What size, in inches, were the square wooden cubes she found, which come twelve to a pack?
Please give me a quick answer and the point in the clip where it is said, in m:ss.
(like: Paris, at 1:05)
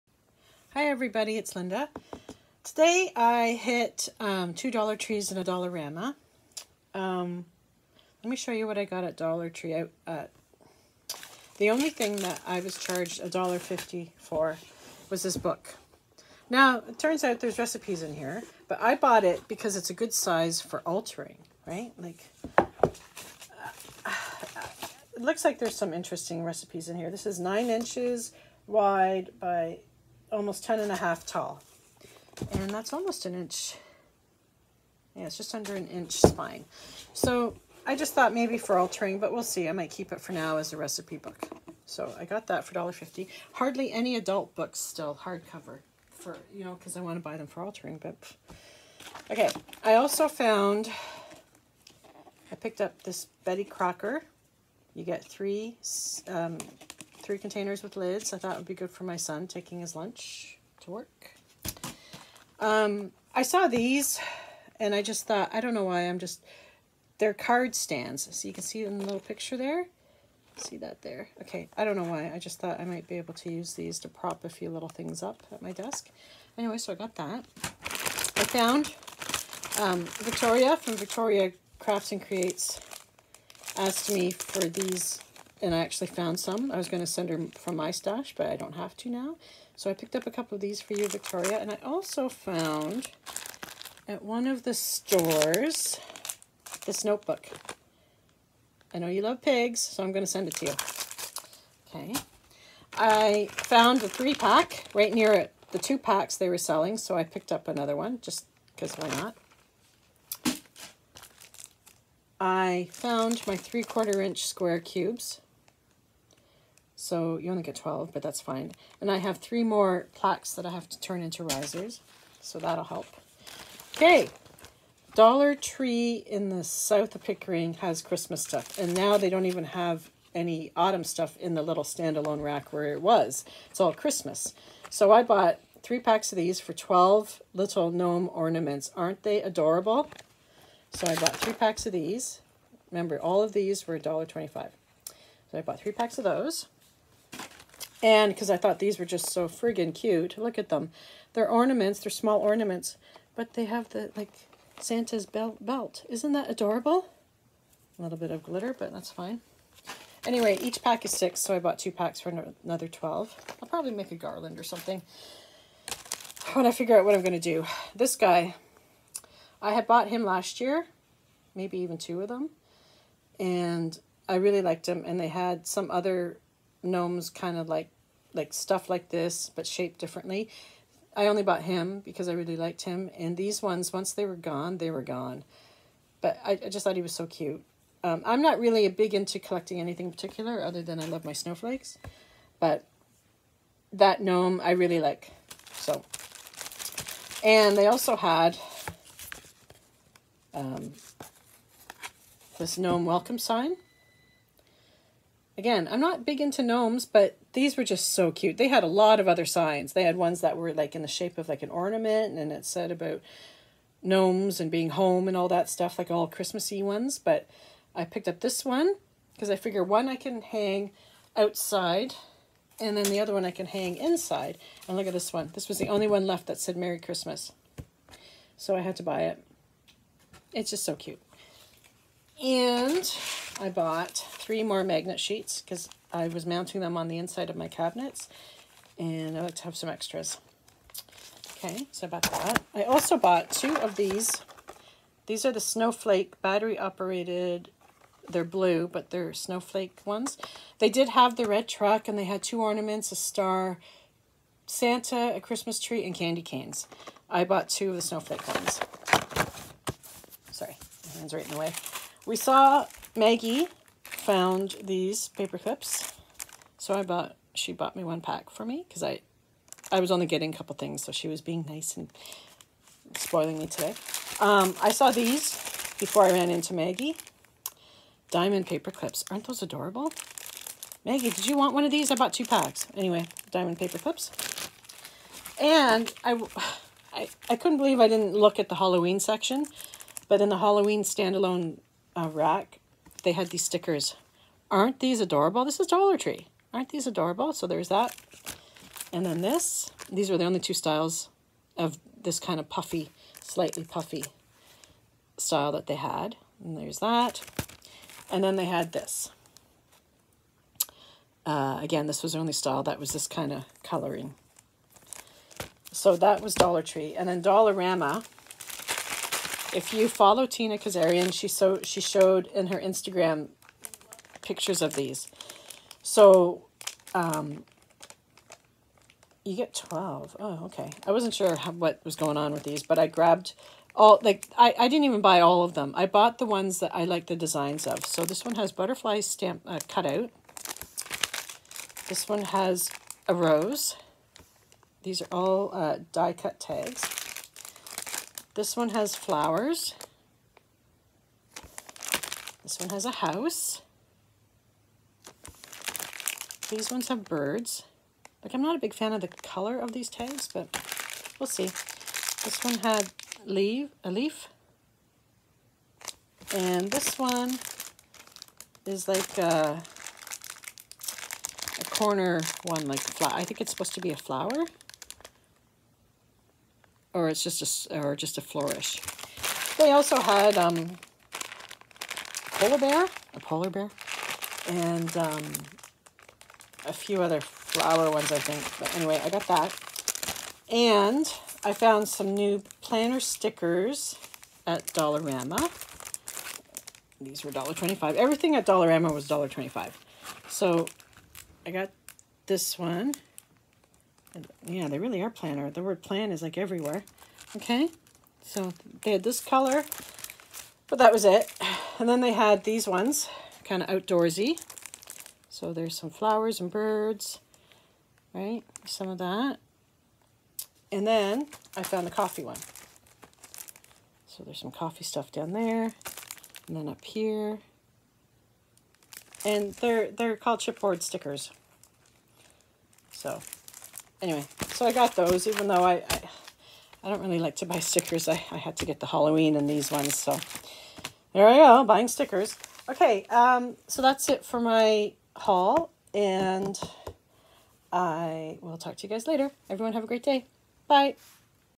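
3/4 inch, at 1:53.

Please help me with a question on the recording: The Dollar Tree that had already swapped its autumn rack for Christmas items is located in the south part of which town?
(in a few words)
Pickering.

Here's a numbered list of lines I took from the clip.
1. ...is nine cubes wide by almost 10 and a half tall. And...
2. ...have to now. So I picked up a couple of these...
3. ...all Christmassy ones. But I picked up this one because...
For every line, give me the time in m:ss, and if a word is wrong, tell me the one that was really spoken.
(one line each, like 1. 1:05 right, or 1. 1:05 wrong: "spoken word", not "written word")
1. 0:27 wrong: "inches", not "cubes"
2. 1:28 right
3. 3:36 right.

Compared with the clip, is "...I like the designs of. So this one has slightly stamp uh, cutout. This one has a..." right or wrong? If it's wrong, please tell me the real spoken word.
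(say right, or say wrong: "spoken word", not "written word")
wrong: "butterfly", not "slightly".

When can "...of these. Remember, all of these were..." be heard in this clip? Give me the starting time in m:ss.
2:21.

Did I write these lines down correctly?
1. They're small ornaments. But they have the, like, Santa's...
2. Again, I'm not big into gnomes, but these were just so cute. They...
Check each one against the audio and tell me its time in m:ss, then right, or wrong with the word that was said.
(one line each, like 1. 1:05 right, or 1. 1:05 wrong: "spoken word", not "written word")
1. 2:31 right
2. 3:25 right.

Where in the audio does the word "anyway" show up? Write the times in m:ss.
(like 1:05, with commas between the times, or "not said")
1:16, 2:40, 4:42, 6:28, 7:14.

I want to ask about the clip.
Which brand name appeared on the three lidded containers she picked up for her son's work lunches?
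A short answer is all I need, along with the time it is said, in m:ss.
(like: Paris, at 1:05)
Betty Crocker, at 0:53.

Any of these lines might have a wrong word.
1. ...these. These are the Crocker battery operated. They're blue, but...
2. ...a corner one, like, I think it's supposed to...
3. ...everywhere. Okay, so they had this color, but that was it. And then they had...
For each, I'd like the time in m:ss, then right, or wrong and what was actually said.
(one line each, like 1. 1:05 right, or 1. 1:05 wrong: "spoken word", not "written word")
1. 4:03 wrong: "Snowflake", not "Crocker"
2. 6:11 right
3. 6:46 right.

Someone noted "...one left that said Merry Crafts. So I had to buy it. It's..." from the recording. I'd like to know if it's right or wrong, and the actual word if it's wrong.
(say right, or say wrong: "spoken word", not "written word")
wrong: "Christmas", not "Crafts".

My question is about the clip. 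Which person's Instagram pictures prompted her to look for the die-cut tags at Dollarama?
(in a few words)
Tina Kazarian.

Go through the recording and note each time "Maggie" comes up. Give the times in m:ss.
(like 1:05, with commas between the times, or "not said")
4:23, 4:36, 4:41.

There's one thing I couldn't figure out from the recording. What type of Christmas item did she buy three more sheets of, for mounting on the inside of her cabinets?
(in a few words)
Magnet sheets.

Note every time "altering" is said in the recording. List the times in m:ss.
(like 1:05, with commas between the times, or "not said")
0:20, 0:38, 0:47.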